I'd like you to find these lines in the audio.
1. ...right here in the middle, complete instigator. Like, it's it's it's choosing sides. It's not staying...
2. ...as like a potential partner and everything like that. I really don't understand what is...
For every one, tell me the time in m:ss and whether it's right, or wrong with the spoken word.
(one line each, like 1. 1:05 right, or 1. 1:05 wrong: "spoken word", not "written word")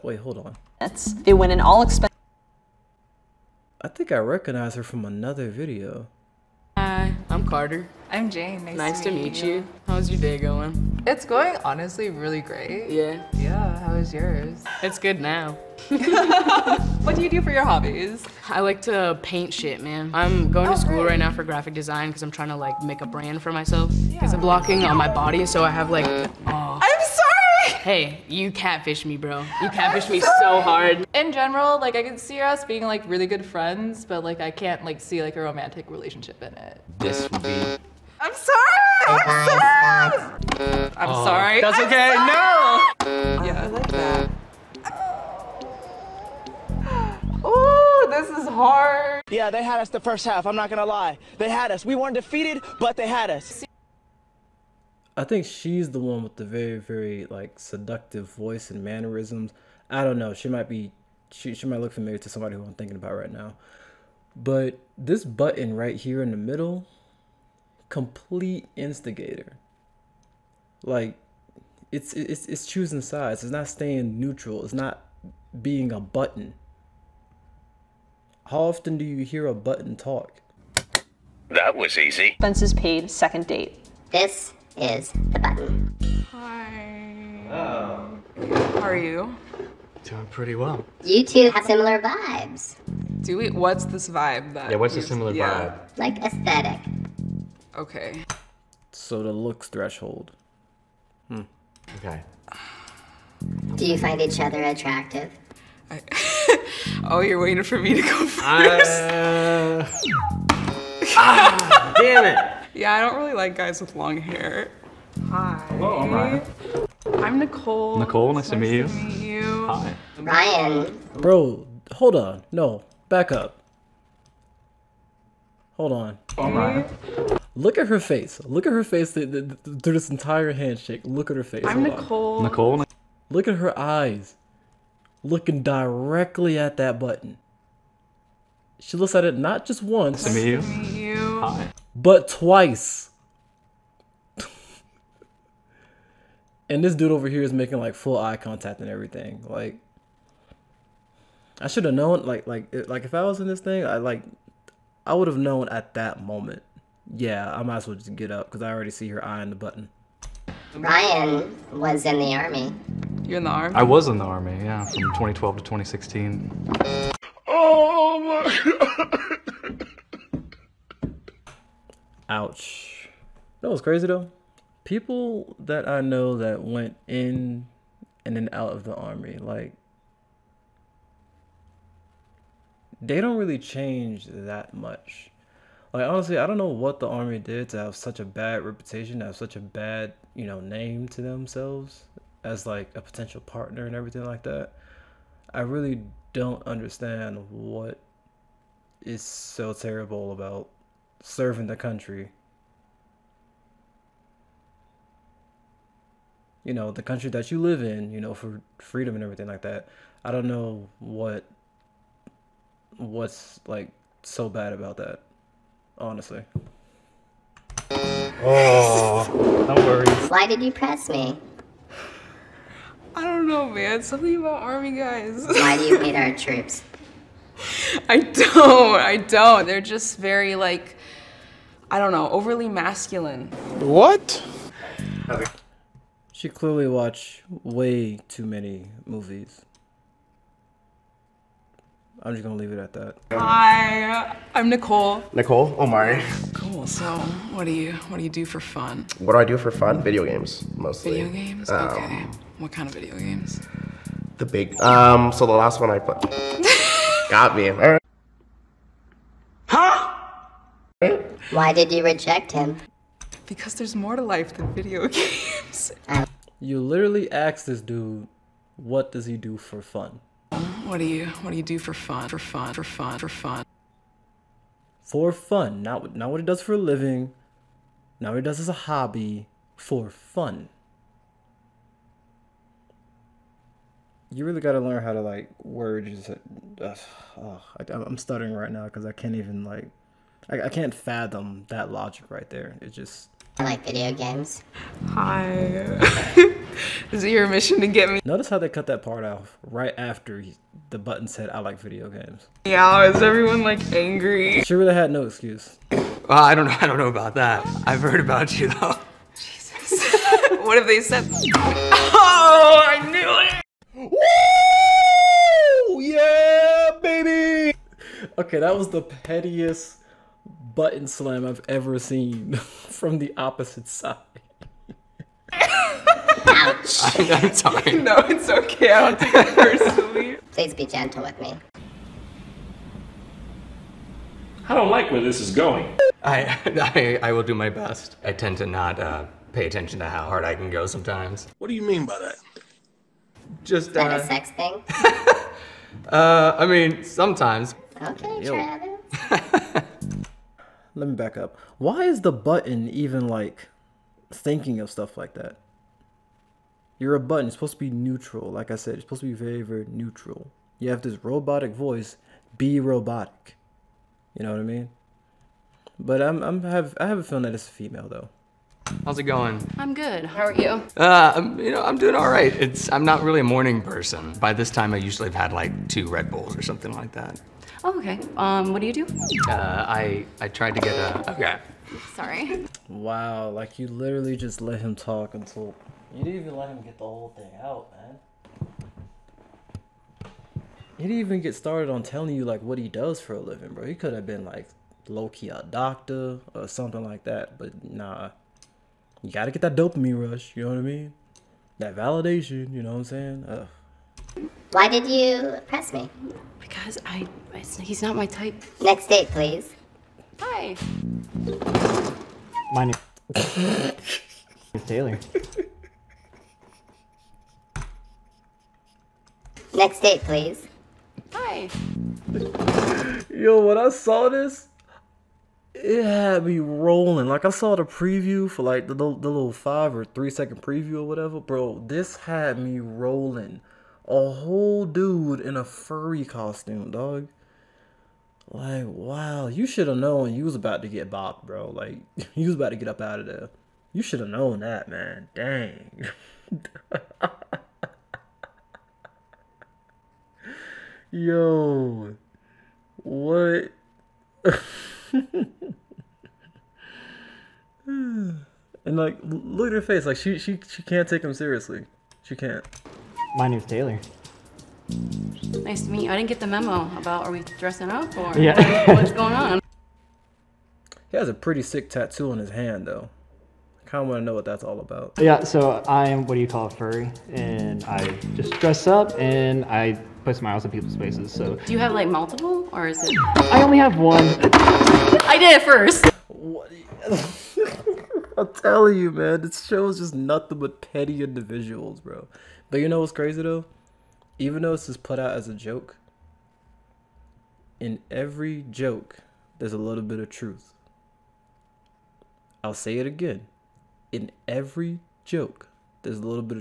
1. 1:05 right
2. 3:12 right.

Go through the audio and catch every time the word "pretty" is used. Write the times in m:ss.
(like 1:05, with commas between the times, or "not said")
1:30, 7:51.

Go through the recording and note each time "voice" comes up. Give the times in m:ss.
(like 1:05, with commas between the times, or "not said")
0:58, 6:01.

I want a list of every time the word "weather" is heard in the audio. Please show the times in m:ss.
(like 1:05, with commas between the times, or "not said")
not said.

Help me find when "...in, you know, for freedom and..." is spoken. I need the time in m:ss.
3:27.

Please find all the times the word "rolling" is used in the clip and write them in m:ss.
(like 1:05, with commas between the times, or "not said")
7:06, 7:12.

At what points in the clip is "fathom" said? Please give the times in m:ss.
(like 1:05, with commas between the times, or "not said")
4:50.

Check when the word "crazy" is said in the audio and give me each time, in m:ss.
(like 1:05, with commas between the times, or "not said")
2:53, 8:13.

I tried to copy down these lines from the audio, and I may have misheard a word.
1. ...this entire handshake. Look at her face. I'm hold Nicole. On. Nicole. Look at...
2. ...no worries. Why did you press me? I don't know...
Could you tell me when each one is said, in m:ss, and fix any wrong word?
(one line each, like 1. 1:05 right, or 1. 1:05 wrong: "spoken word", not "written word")
1. 2:09 right
2. 3:39 right.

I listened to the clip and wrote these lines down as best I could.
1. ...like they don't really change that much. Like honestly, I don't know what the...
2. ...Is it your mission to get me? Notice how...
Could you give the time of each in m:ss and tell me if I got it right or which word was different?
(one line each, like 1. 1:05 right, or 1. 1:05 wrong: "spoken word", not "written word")
1. 2:59 right
2. 4:57 right.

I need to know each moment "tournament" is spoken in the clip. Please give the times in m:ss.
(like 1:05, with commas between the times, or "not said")
not said.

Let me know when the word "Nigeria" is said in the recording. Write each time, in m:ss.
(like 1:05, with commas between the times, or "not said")
not said.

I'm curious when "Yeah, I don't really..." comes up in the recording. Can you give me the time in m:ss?
1:52.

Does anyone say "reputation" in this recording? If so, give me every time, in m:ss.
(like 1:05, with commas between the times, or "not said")
3:08.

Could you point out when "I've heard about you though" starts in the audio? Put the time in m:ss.
5:07.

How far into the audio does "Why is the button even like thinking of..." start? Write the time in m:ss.
5:51.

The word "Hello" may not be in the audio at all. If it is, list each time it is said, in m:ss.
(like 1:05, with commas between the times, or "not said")
1:27, 1:55.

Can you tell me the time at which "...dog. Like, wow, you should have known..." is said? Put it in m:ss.
7:16.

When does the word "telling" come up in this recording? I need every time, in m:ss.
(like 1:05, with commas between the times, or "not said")
6:32, 8:08.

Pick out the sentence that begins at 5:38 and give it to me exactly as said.
I tend to not uh, pay attention to how hard I can go sometimes.